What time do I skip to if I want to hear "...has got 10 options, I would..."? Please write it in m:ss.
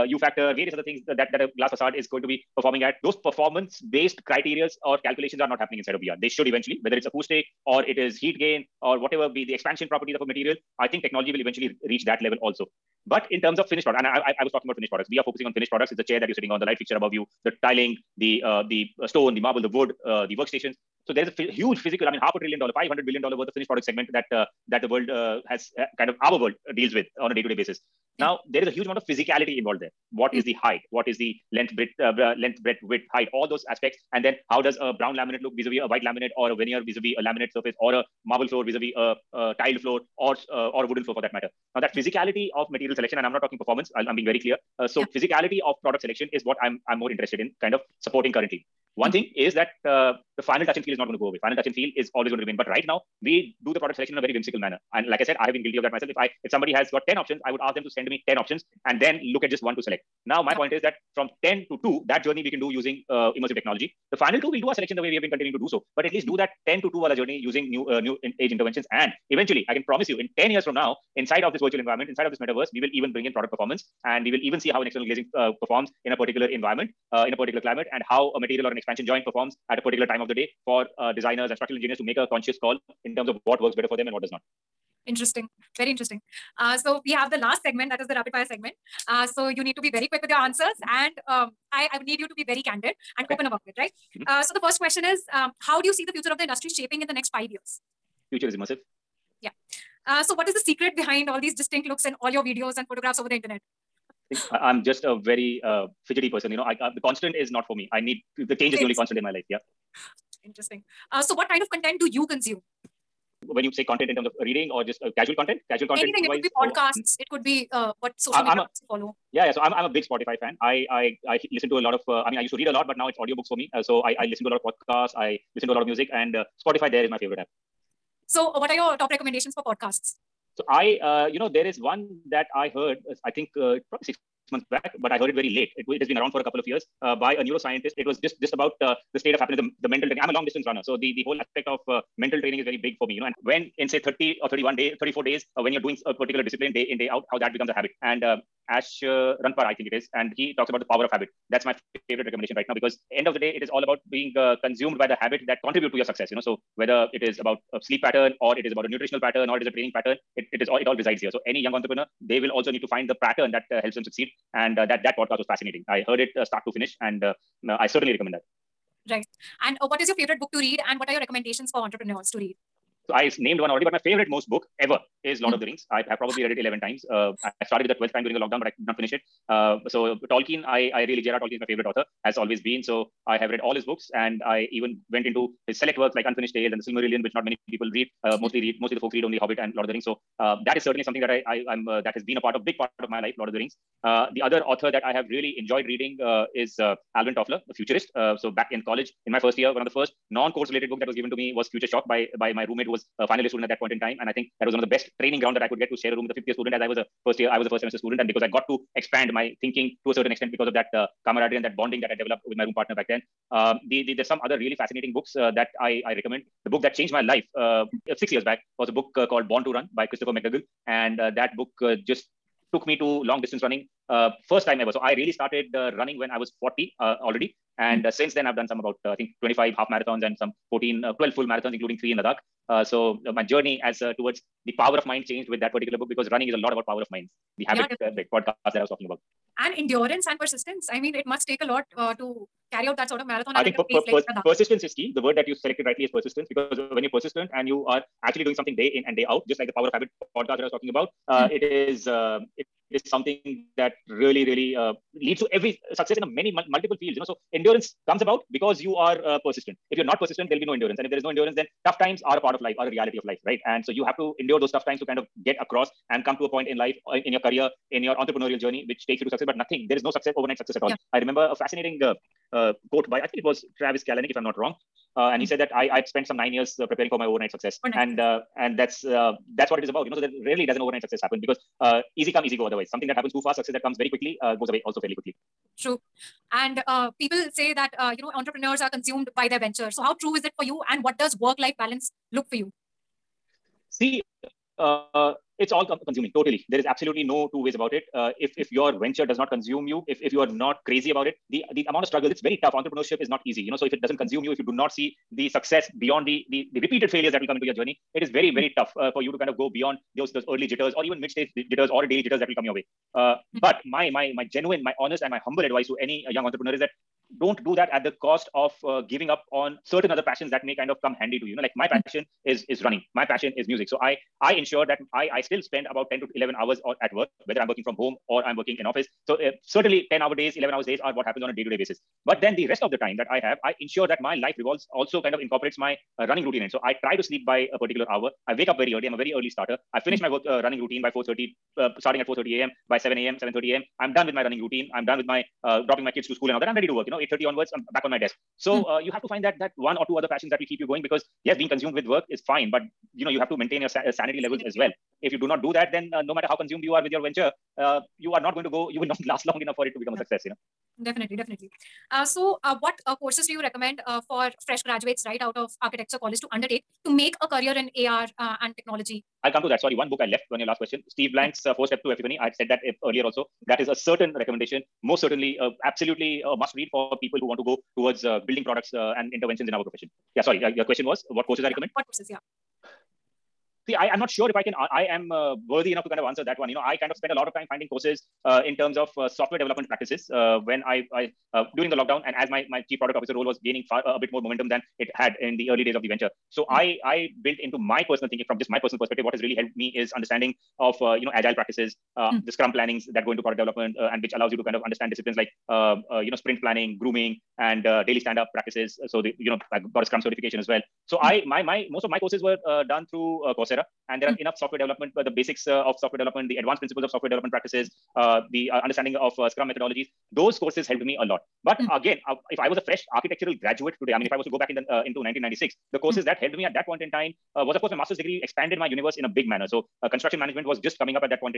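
0:56.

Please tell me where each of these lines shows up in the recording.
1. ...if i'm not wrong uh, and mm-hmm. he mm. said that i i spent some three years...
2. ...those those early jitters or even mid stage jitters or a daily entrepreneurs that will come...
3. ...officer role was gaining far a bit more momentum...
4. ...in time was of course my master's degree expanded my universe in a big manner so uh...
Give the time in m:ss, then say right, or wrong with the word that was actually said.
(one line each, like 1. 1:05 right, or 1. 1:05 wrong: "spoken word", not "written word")
1. 4:34 wrong: "nine", not "three"
2. 5:10 wrong: "jitters", not "entrepreneurs"
3. 6:33 right
4. 7:07 right.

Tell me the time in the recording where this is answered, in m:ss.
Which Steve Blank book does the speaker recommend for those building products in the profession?
6:11.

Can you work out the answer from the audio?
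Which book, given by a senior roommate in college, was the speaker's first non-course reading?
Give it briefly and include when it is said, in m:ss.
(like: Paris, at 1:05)
Future Shock, at 3:21.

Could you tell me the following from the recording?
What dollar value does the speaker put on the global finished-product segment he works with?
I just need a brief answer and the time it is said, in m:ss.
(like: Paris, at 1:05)
500 billion dollars, at 0:22.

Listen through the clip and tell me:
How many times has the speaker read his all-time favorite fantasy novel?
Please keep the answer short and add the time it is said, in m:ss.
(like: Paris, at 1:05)
11, at 2:56.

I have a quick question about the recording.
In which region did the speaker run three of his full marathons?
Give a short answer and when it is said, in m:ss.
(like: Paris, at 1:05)
Ladakh, at 3:52.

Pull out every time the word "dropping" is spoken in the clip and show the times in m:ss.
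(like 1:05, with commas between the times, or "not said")
5:45.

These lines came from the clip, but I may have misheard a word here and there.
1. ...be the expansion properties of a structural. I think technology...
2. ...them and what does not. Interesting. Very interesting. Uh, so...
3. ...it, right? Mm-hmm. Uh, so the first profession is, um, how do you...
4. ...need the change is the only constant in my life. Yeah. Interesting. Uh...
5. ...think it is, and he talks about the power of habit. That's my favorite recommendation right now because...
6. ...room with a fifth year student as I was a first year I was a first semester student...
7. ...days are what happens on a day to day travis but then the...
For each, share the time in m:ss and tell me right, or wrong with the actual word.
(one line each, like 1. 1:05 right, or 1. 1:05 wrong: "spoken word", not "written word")
1. 0:09 wrong: "material", not "structural"
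2. 1:23 right
3. 1:33 wrong: "question", not "profession"
4. 1:48 right
5. 2:29 right
6. 3:26 right
7. 5:30 wrong: "basis", not "travis".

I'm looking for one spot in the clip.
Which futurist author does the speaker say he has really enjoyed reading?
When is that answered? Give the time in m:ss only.
3:17.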